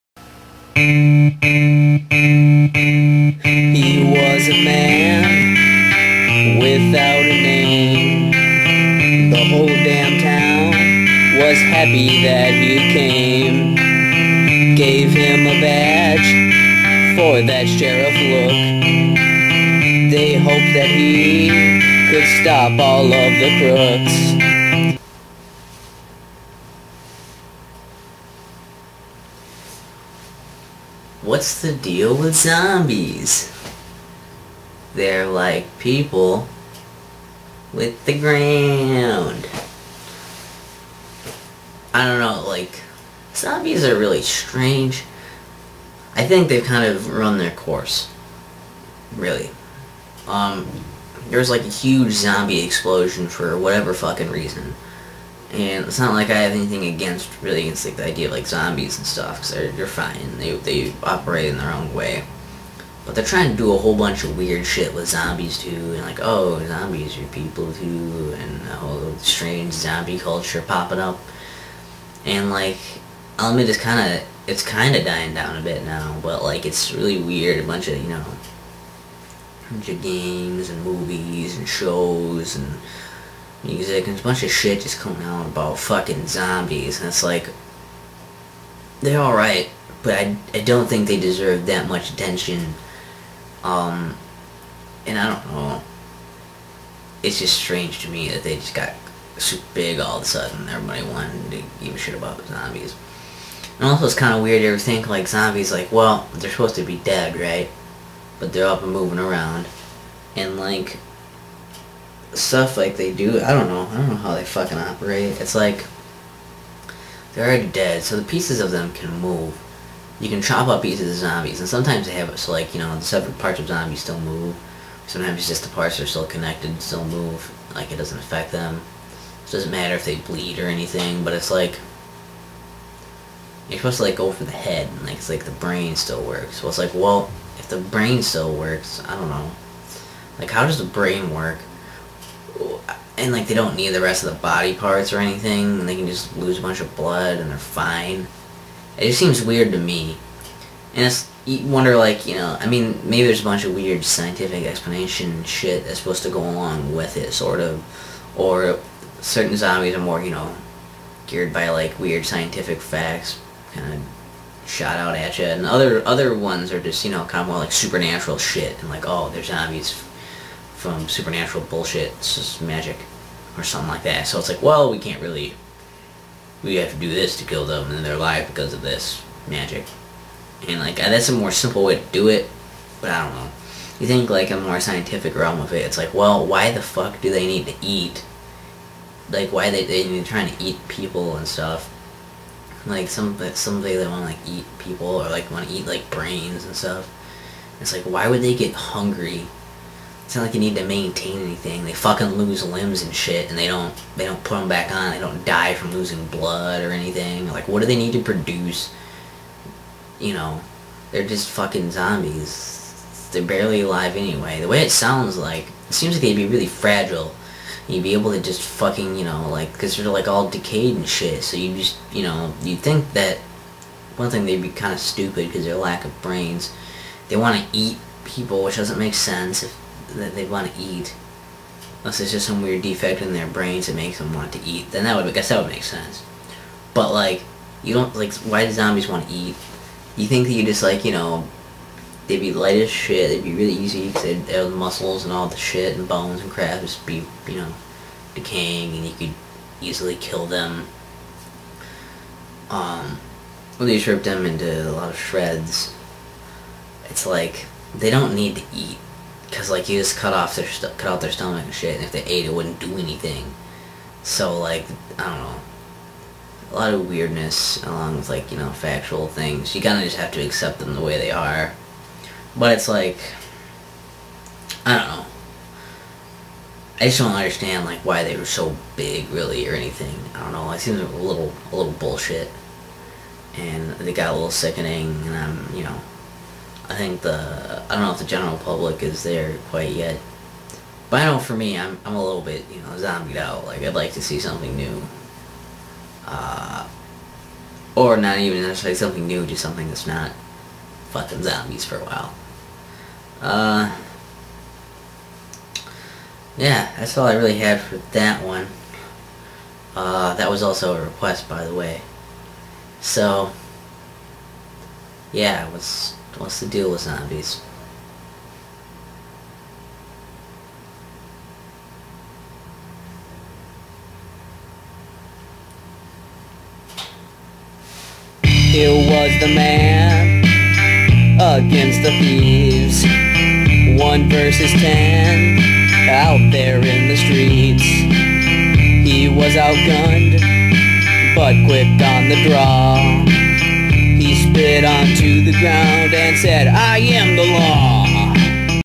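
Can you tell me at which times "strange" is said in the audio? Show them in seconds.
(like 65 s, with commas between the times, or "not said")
44 s, 69 s, 97 s.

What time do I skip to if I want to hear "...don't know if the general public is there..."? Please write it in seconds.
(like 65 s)
287 s.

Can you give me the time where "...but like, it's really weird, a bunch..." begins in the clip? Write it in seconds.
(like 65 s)
76 s.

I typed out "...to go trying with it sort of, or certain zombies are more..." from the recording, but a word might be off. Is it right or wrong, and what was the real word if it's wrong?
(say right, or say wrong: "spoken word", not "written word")
wrong: "along", not "trying".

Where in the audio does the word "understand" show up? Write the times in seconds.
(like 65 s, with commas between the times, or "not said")
277 s.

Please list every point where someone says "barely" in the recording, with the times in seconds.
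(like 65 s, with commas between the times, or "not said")
213 s.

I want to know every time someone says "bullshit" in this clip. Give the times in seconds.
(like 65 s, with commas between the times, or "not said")
171 s, 281 s.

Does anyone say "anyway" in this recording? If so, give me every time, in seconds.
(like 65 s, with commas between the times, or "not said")
214 s.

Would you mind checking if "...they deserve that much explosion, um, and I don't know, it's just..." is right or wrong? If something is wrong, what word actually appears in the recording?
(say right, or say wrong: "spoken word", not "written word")
wrong: "attention", not "explosion".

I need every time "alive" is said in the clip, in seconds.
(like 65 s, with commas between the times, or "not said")
178 s, 213 s.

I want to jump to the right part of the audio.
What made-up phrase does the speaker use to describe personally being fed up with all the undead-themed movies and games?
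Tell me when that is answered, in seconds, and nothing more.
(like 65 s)
292 s.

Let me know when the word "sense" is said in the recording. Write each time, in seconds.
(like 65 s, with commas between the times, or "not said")
229 s, 235 s.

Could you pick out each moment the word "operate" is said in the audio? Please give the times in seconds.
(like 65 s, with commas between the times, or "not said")
61 s, 114 s.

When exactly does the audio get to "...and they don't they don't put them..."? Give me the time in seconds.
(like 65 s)
203 s.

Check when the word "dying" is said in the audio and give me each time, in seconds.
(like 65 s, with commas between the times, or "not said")
75 s.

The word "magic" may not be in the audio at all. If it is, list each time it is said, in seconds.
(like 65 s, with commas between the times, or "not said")
172 s, 179 s.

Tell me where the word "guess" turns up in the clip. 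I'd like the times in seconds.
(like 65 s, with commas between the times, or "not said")
235 s.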